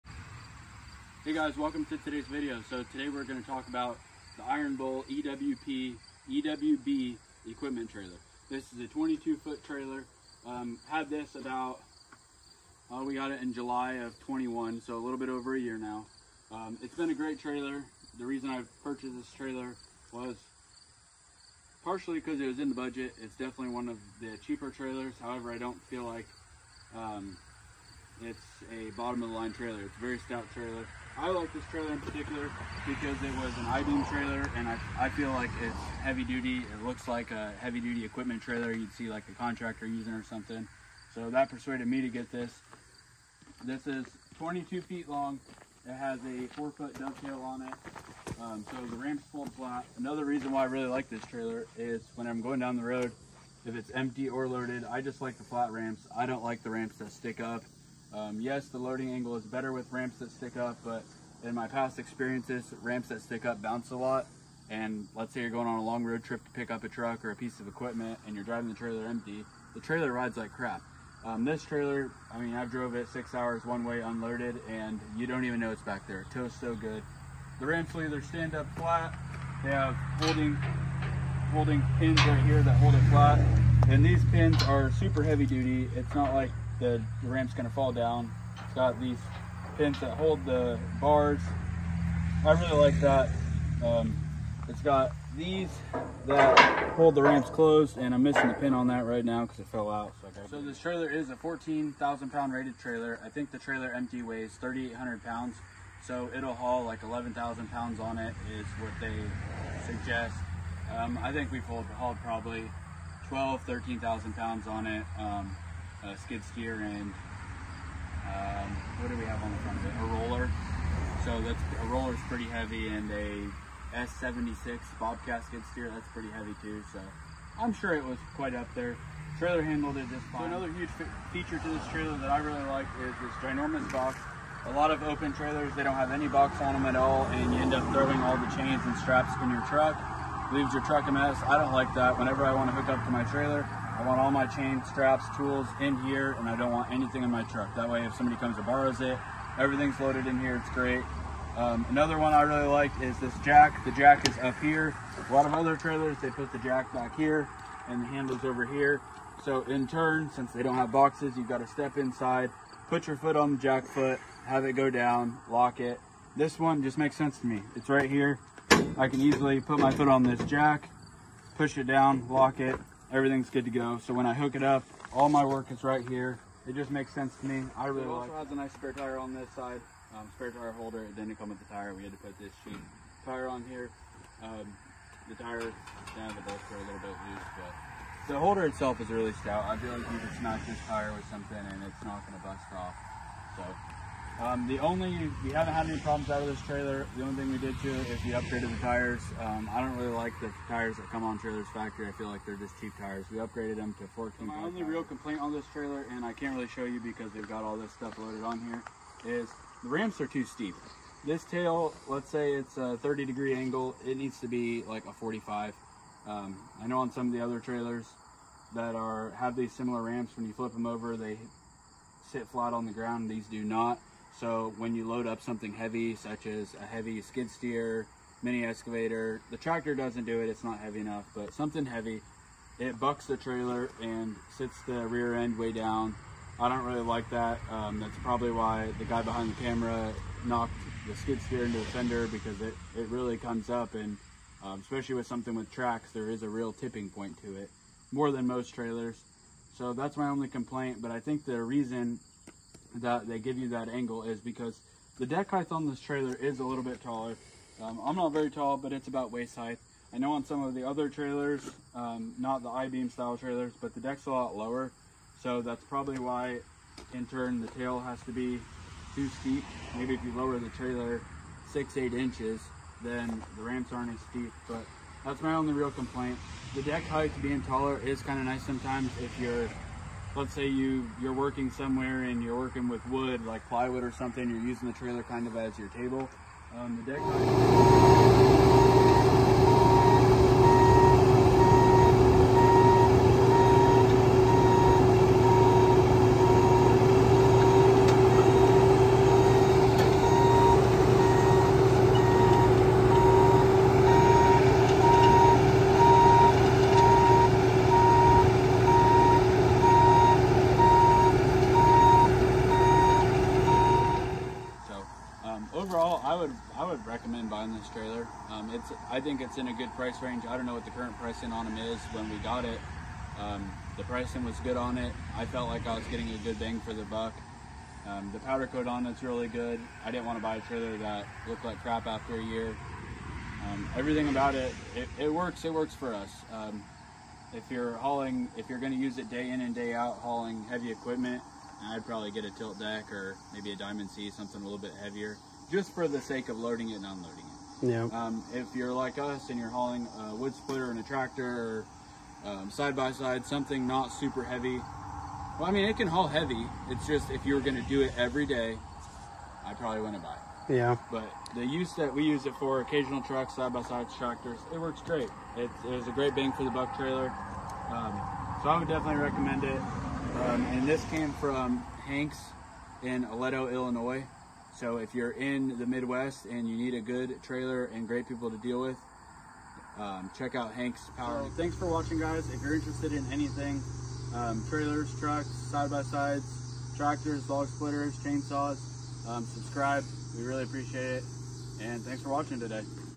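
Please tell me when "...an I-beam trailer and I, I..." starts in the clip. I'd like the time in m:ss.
0:33.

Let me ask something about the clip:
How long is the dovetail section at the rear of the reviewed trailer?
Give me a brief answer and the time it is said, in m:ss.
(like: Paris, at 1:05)
4 feet, at 0:46.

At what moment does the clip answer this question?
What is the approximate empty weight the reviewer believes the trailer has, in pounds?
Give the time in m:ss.
1:44.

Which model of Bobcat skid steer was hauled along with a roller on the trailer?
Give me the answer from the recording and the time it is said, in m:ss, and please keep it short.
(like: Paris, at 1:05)
S76, at 2:03.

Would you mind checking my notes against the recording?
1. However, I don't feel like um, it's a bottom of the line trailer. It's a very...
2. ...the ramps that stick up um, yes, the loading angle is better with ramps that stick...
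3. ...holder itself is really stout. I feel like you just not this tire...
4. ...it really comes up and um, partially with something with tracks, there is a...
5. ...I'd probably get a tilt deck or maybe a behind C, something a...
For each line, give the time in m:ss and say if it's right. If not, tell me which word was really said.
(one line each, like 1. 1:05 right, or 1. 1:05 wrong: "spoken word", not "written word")
1. 0:25 right
2. 0:56 right
3. 3:08 right
4. 4:02 wrong: "especially", not "partially"
5. 5:41 wrong: "diamond", not "behind".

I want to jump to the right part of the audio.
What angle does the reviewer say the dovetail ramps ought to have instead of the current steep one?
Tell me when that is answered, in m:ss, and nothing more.
3:35.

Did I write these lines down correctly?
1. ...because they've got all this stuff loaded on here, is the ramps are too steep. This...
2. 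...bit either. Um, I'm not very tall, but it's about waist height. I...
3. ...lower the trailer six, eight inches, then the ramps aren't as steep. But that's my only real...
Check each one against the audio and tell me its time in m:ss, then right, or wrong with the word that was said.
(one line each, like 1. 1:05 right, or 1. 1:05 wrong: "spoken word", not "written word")
1. 3:26 right
2. 4:16 wrong: "taller", not "either"
3. 4:30 right.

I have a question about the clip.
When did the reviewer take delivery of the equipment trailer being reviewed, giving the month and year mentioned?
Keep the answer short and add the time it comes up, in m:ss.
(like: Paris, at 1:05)
July 2021, at 0:13.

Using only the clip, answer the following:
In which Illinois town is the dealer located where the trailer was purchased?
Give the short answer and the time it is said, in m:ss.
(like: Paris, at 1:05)
Aledo, at 6:13.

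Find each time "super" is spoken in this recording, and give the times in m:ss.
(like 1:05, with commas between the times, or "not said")
1:24, 5:54.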